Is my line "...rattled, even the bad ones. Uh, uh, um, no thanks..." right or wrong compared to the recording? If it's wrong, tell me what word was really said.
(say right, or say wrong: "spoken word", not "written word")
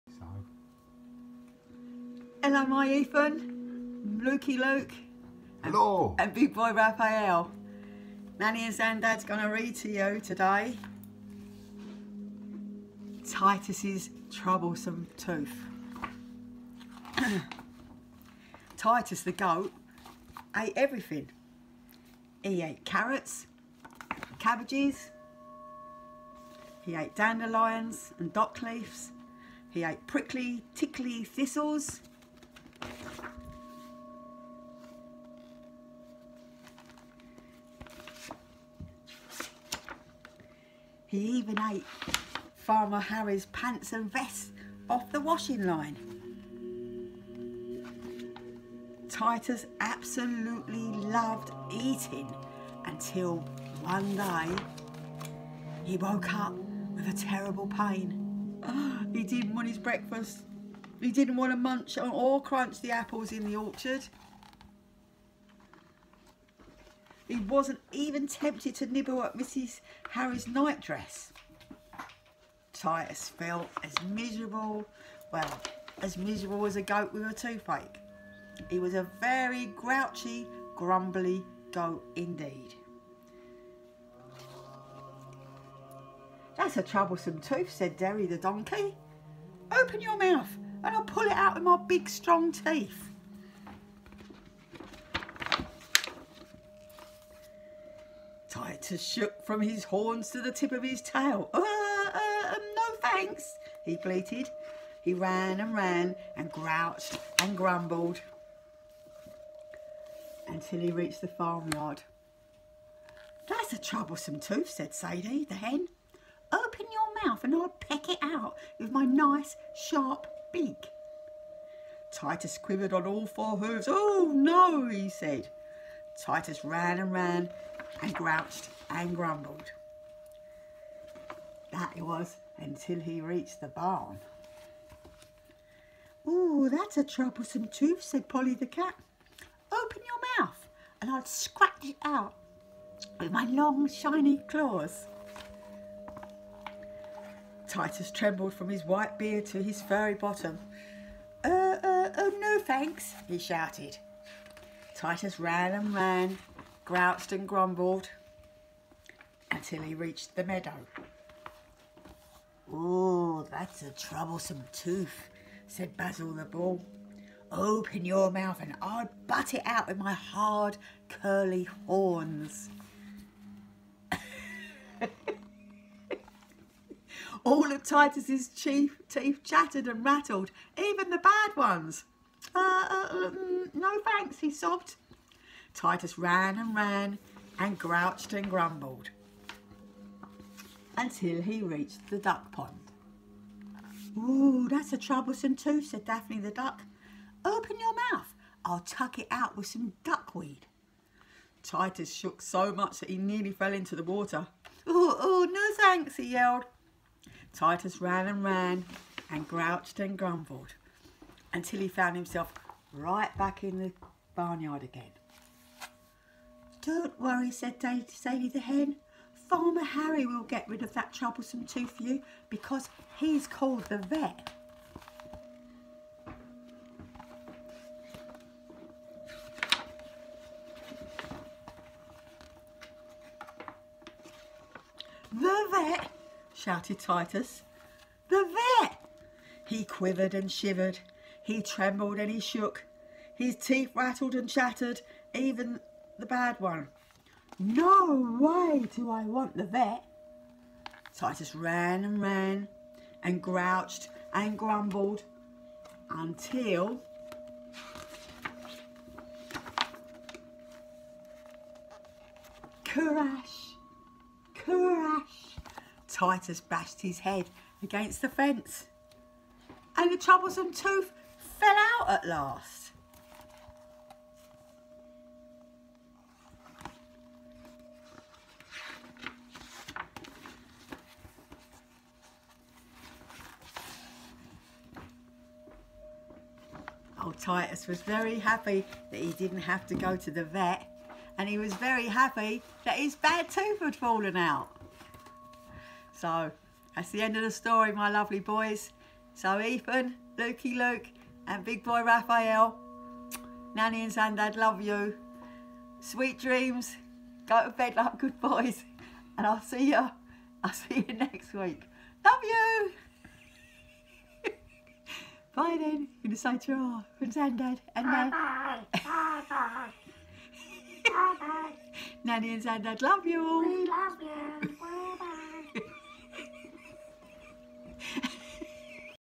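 right.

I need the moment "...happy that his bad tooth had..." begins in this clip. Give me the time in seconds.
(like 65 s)
292 s.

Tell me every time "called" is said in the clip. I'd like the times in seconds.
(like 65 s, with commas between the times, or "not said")
223 s.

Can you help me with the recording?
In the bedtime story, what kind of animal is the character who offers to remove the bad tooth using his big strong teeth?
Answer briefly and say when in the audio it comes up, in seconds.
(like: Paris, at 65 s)
donkey, at 88 s.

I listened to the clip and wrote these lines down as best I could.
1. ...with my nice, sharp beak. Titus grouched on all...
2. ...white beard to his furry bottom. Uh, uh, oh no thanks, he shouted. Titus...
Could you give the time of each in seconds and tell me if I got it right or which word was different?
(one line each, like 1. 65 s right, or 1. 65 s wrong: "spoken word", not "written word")
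1. 118 s wrong: "quivered", not "grouched"
2. 148 s right.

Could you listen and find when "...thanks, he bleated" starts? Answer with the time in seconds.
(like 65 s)
103 s.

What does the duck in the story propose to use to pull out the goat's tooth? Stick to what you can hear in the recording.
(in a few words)
duckweed.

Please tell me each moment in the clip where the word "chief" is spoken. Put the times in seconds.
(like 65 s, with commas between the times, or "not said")
178 s.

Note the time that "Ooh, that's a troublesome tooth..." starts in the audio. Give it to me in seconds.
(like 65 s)
194 s.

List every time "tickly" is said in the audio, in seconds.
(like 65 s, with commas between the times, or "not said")
30 s.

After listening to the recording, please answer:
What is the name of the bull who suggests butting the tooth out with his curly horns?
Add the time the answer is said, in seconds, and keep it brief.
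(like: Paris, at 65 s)
Basil, at 165 s.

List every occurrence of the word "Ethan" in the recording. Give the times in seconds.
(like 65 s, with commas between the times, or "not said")
2 s, 299 s.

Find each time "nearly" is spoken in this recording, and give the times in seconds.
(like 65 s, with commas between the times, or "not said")
203 s.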